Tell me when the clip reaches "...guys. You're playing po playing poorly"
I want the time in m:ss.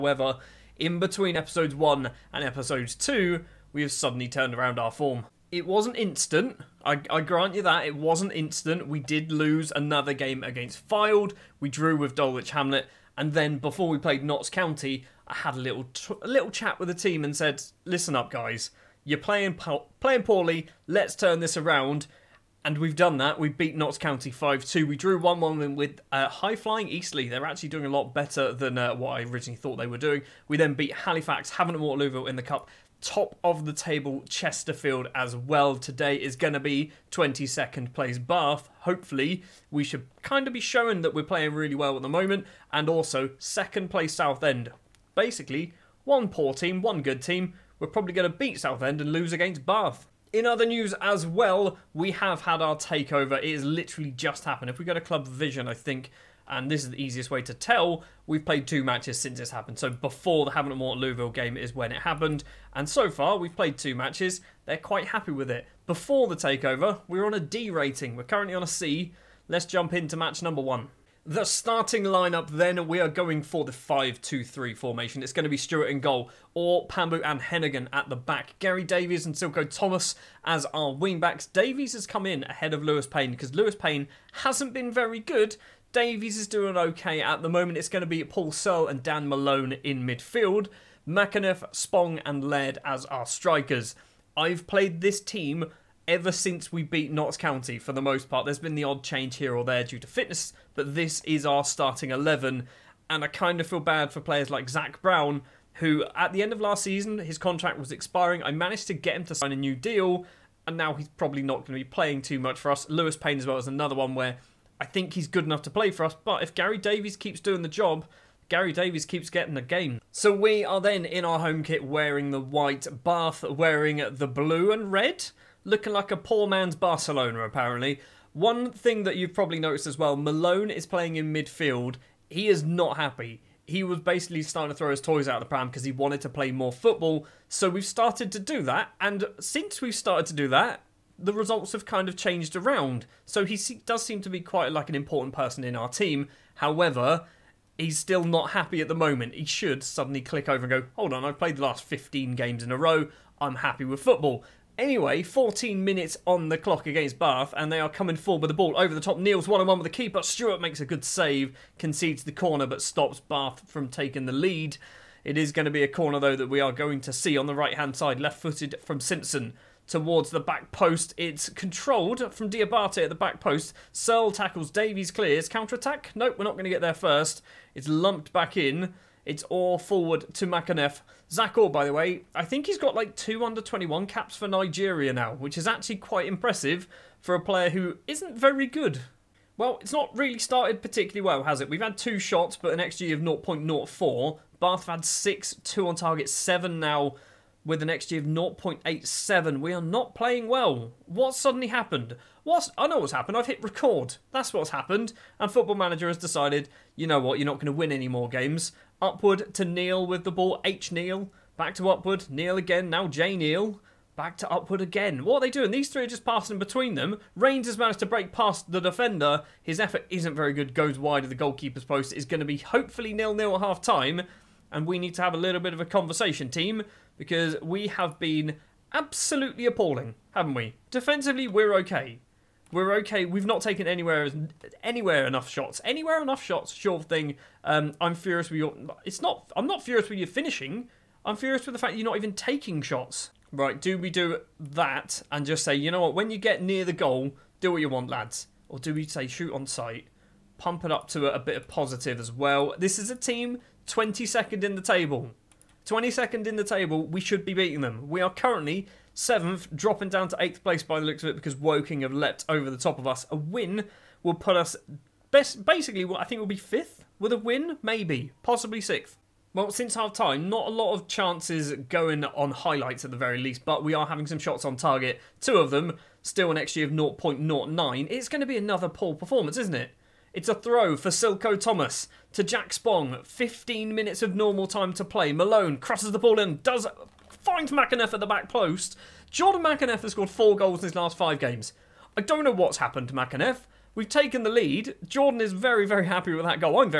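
0:18.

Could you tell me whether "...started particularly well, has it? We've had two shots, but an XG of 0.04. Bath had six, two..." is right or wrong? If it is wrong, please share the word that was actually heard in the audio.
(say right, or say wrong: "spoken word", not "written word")
right.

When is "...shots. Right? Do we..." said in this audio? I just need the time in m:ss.
4:02.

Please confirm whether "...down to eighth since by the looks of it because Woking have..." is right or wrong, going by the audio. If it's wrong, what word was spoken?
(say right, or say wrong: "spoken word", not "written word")
wrong: "place", not "since".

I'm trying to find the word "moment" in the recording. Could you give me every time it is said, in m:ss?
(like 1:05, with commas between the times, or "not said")
0:42, 1:27, 2:28.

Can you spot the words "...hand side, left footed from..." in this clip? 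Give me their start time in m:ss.
2:47.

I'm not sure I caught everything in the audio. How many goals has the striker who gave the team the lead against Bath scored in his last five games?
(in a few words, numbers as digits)
4.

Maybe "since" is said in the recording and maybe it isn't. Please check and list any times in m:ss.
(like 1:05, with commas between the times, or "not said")
0:59, 1:36, 2:19, 4:29.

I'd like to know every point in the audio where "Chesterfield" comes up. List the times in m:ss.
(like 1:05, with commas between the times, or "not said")
0:34.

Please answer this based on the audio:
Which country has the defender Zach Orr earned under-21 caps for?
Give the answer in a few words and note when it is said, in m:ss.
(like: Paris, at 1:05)
Nigeria, at 3:04.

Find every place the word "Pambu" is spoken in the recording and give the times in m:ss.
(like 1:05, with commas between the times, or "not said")
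1:16.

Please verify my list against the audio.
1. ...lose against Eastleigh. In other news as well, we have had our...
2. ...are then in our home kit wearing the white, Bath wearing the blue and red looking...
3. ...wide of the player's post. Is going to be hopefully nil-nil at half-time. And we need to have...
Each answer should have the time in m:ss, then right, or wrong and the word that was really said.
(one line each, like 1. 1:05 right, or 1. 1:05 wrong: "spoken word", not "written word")
1. 0:49 wrong: "Bath", not "Eastleigh"
2. 2:00 right
3. 3:40 wrong: "goalkeeper", not "player".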